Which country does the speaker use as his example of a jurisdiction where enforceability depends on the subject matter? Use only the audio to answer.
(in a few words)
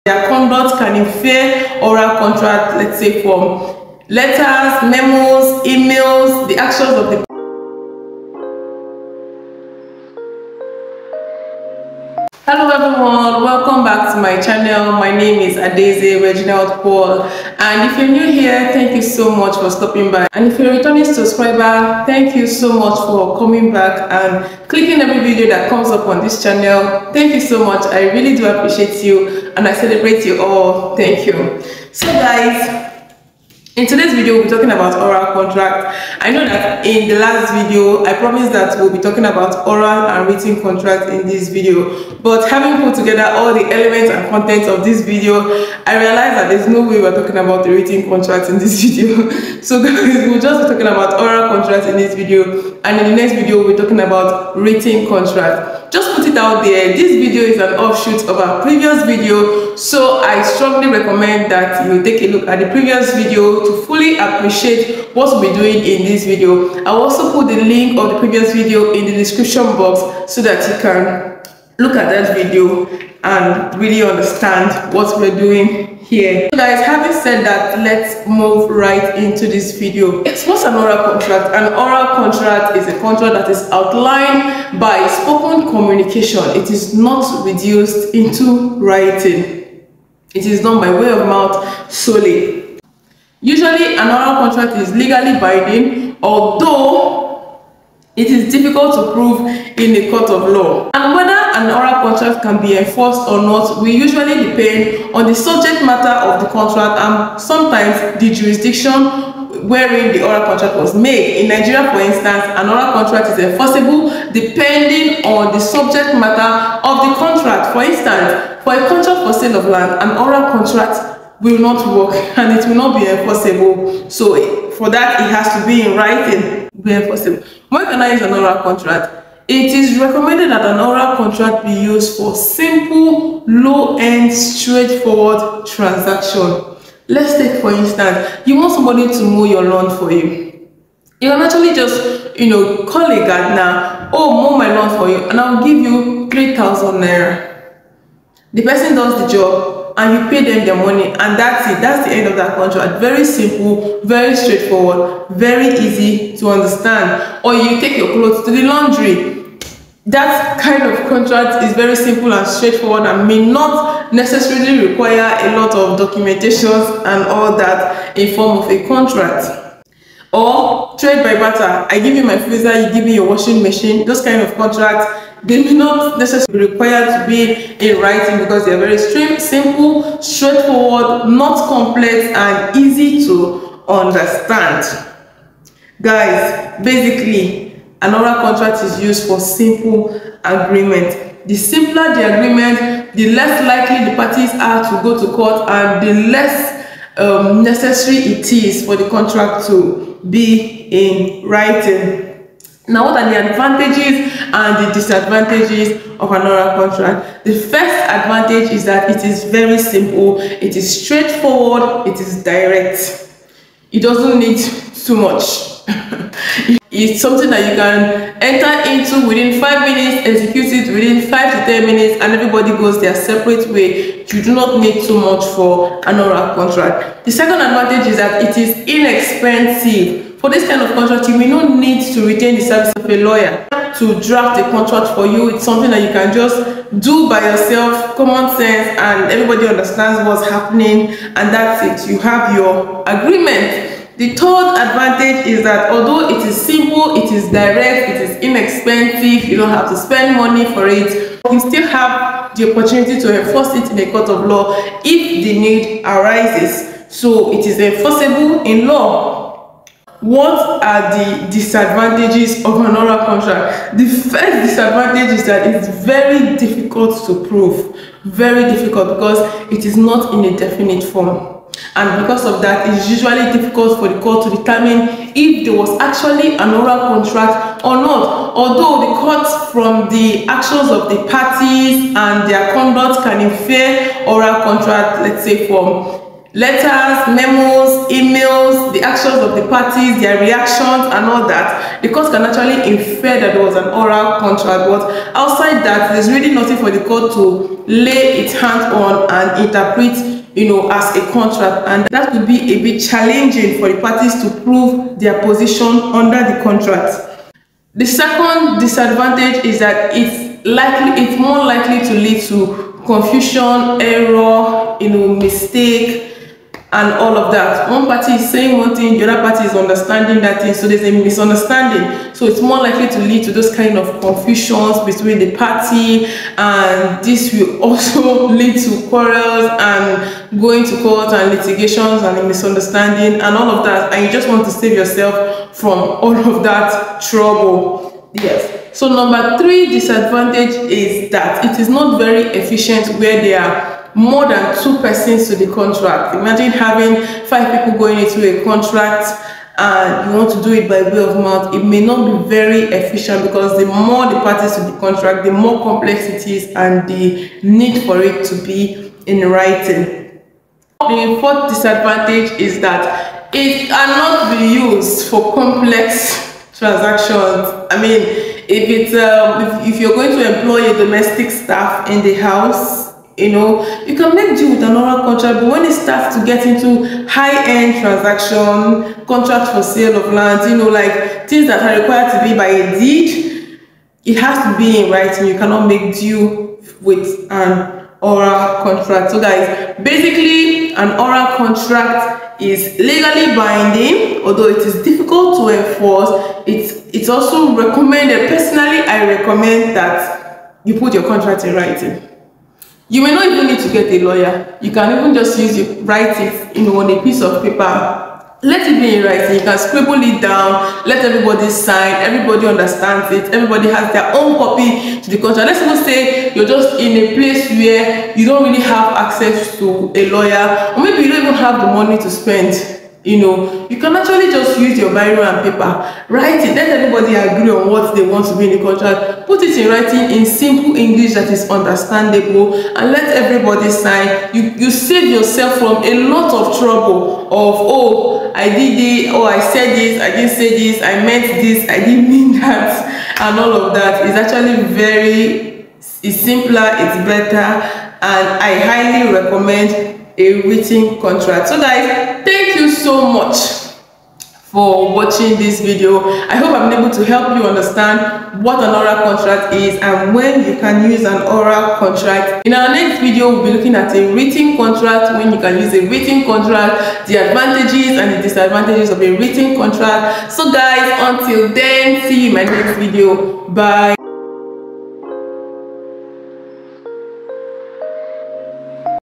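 Nigeria.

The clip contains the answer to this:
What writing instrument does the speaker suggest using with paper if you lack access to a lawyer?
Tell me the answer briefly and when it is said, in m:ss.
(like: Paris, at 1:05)
biro, at 7:05.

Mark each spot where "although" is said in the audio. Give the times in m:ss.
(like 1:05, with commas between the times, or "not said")
1:36, 4:05, 4:38, 6:34.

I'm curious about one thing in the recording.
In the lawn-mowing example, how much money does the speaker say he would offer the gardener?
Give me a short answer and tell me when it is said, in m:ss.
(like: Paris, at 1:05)
3,000 naira, at 2:26.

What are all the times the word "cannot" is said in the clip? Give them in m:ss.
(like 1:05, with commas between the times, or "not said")
6:03, 6:25.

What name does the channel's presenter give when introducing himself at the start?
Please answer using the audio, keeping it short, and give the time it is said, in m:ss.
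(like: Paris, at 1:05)
Adeze Reginald Paul, at 0:15.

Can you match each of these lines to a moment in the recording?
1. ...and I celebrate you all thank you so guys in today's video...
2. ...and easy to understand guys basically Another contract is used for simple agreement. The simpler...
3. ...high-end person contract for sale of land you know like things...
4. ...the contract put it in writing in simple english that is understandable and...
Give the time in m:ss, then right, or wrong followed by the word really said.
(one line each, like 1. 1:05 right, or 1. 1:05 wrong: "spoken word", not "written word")
1. 0:29 right
2. 3:02 right
3. 6:17 wrong: "transaction", not "person"
4. 7:08 right.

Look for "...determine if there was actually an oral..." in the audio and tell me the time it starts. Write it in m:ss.
4:34.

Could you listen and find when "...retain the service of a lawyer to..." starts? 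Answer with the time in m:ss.
3:52.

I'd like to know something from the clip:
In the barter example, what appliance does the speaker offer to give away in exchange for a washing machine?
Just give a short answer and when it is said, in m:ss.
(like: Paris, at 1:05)
freezer, at 2:52.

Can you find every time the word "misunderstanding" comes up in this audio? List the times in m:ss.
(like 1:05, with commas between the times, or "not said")
5:21, 5:32.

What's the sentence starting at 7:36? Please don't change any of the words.
I hope I'm able to help you understand what an oral contract is and when you can use an oral contract.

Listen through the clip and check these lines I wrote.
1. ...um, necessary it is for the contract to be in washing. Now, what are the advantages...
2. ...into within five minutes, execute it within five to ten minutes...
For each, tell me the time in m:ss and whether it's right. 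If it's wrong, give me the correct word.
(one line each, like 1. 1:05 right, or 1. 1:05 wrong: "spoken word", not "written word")
1. 3:17 wrong: "writing", not "washing"
2. 3:38 right.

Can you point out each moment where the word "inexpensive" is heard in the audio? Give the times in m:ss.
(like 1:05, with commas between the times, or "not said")
3:48, 4:08.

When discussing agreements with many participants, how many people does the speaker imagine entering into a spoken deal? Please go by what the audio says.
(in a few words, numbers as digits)
5.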